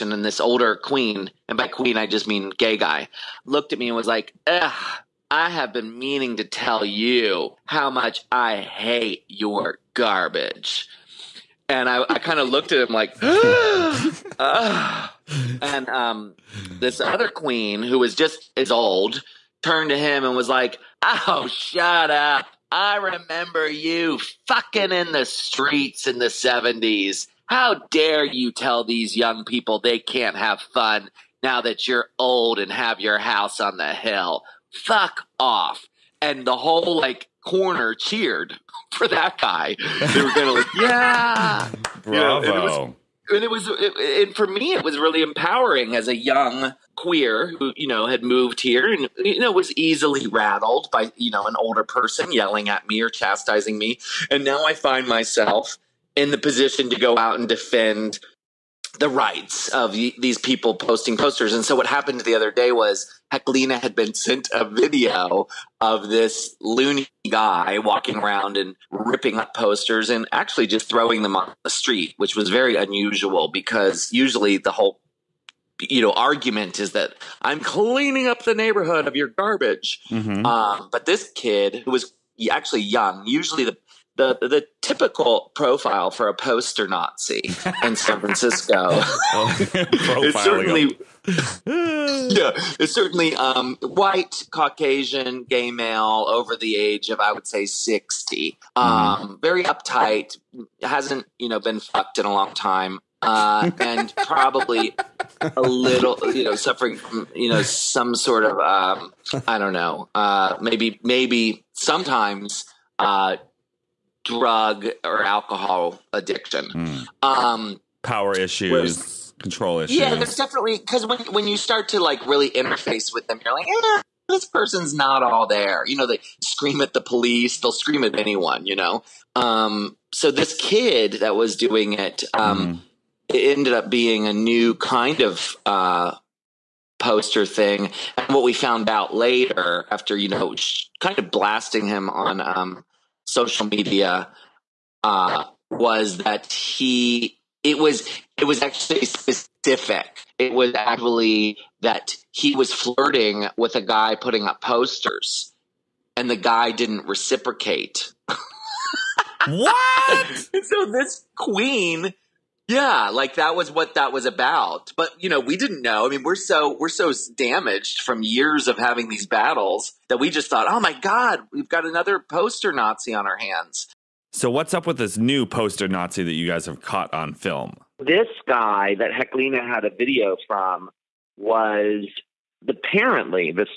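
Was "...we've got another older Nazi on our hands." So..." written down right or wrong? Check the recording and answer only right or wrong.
wrong.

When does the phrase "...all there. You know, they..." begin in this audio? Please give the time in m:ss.
2:05.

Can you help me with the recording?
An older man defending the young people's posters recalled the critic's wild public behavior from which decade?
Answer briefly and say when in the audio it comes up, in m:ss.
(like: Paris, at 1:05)
70s, at 0:26.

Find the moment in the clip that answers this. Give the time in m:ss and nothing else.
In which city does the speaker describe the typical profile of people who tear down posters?
1:27.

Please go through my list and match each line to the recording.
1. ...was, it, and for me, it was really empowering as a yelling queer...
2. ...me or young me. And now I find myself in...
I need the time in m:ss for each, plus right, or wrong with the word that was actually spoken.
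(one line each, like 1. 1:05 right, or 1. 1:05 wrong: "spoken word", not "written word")
1. 0:43 wrong: "young", not "yelling"
2. 0:52 wrong: "chastising", not "young".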